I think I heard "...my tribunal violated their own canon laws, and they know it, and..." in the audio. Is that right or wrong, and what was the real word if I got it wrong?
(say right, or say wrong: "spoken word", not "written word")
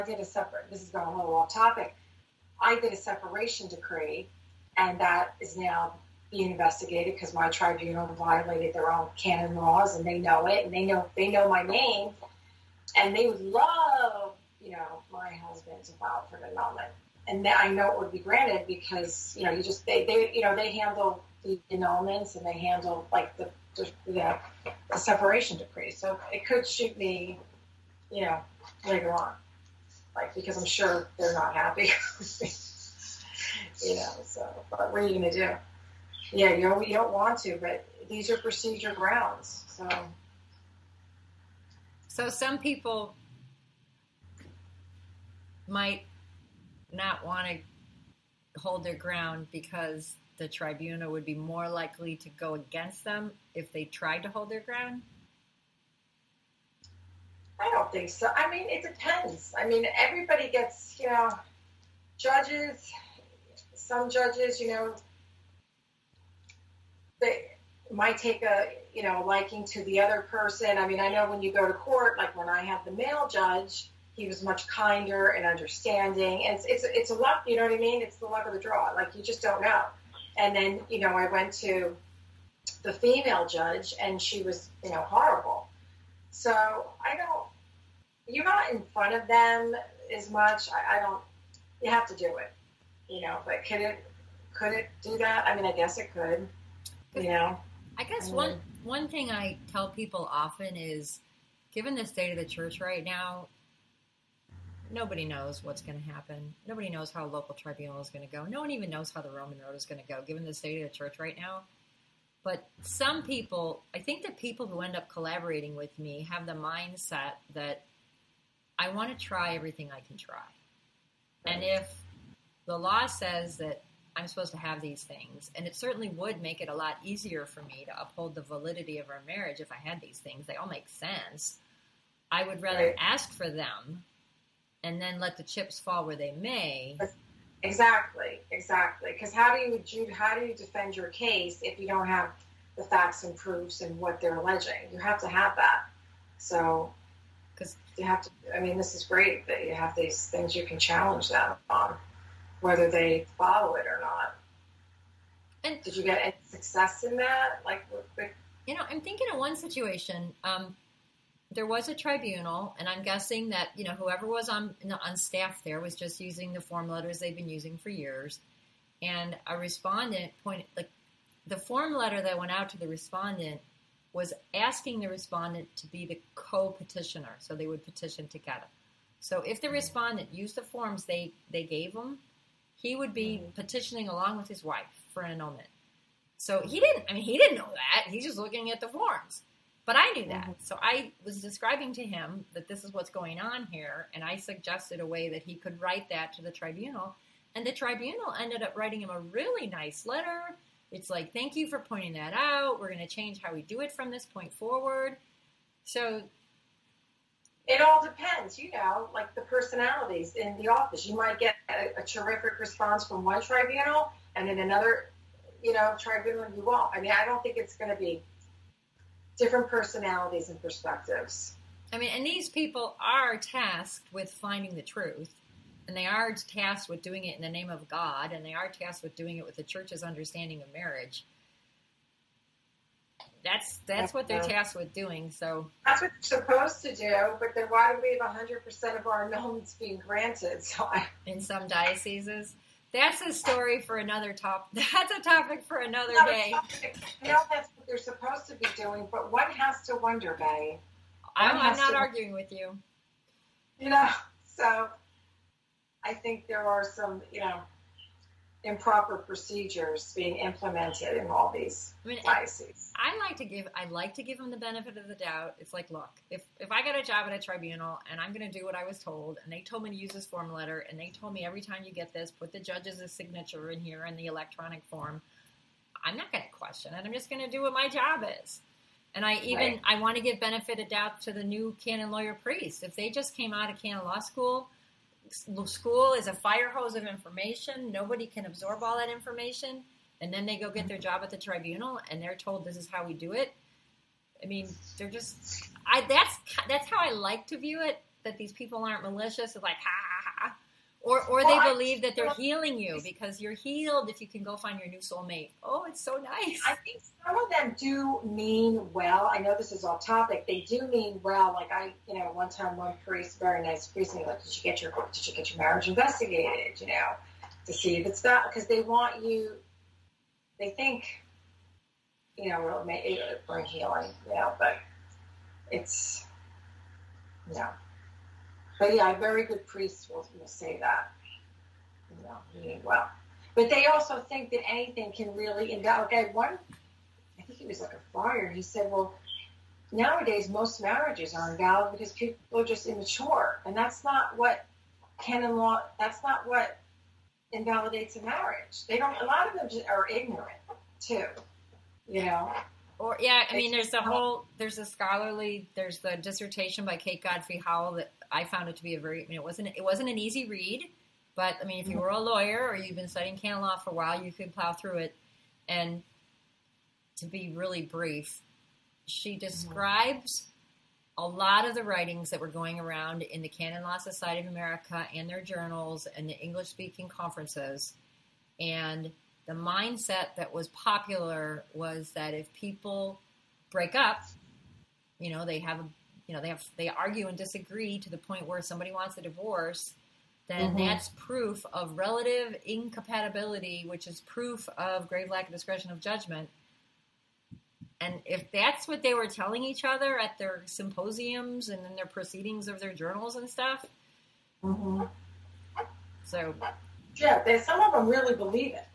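right.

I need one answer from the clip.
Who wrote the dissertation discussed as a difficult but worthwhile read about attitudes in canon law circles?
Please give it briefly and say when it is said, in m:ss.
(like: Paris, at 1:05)
Kate Godfrey Howell, at 5:56.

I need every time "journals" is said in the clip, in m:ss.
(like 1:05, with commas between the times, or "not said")
6:15, 6:42.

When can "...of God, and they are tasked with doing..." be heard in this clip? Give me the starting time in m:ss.
3:47.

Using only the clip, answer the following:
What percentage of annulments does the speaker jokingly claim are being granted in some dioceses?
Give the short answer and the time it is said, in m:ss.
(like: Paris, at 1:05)
100 percent, at 3:58.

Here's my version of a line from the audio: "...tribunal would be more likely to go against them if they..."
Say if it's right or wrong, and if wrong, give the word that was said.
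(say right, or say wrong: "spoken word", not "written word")
right.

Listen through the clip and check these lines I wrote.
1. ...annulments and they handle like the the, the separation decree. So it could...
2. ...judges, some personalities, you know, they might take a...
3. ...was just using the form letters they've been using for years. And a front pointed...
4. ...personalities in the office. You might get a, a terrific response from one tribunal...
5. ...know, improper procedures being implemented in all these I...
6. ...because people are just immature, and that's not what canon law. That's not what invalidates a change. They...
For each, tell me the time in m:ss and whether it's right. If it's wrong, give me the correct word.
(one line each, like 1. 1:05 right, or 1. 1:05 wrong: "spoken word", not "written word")
1. 0:21 right
2. 1:02 wrong: "judges", not "personalities"
3. 2:45 wrong: "respondent", not "front"
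4. 3:29 right
5. 4:17 right
6. 5:41 wrong: "marriage", not "change".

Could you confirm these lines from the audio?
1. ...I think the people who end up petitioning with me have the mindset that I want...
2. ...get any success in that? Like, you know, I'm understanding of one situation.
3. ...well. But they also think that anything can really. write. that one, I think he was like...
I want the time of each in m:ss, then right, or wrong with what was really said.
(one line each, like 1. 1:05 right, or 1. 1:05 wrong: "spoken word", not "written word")
1. 1:53 wrong: "collaborating", not "petitioning"
2. 2:36 wrong: "thinking", not "understanding"
3. 5:32 wrong: "invalidate", not "write".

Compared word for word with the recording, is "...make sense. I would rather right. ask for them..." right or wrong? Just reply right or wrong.
right.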